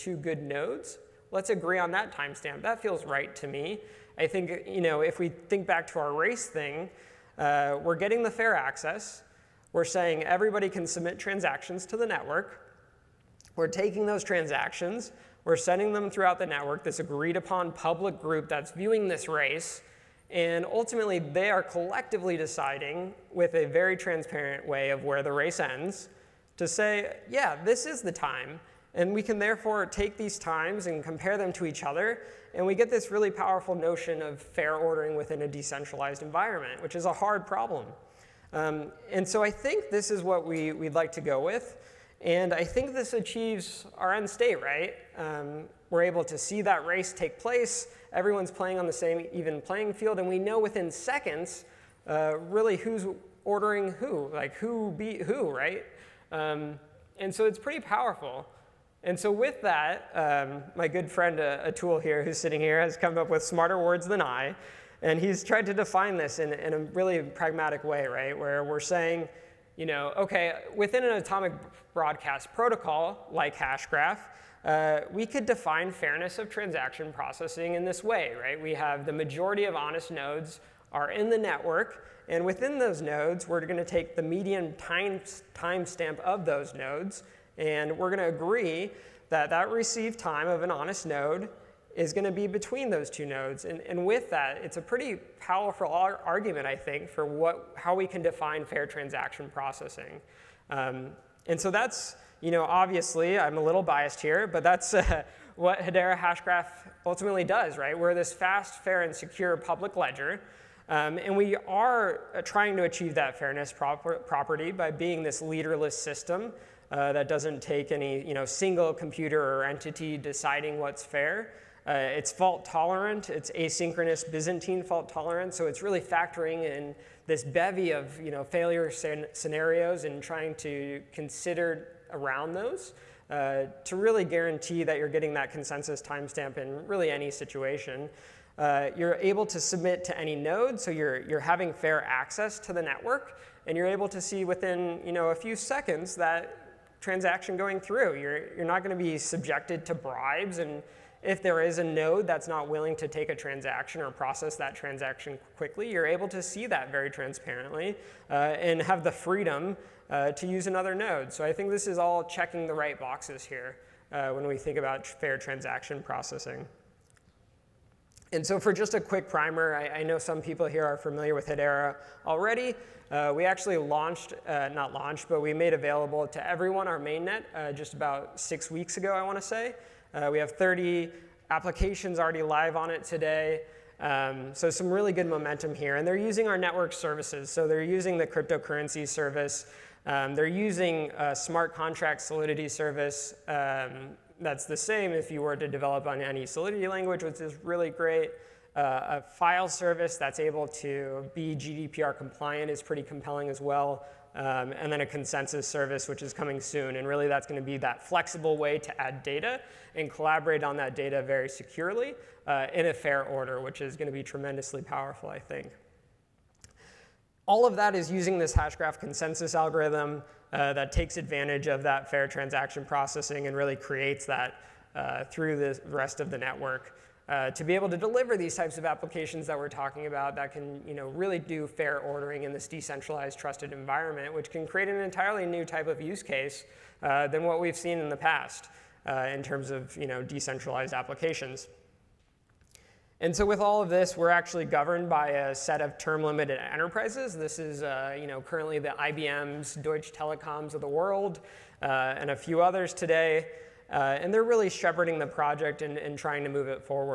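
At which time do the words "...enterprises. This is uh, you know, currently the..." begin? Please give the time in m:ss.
4:06.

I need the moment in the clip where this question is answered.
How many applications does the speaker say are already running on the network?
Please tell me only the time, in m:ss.
3:00.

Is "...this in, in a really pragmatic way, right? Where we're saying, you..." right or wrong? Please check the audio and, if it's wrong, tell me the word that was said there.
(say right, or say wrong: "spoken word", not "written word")
right.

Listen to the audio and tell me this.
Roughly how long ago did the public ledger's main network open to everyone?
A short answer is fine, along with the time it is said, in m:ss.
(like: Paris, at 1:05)
6 weeks, at 2:58.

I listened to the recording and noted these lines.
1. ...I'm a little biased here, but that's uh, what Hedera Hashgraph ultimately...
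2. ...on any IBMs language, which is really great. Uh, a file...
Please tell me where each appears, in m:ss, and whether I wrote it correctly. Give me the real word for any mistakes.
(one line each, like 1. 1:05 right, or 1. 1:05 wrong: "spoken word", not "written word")
1. 1:43 right
2. 3:16 wrong: "Solidity", not "IBMs".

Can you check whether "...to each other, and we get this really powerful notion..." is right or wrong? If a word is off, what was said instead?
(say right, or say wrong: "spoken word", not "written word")
right.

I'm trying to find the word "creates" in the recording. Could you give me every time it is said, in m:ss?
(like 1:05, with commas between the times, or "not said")
3:43, 3:54.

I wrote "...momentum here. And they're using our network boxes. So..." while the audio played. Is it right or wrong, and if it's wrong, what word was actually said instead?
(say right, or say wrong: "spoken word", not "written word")
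wrong: "services", not "boxes".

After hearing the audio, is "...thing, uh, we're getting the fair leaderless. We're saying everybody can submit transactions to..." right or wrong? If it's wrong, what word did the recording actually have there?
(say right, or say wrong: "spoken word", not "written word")
wrong: "access", not "leaderless".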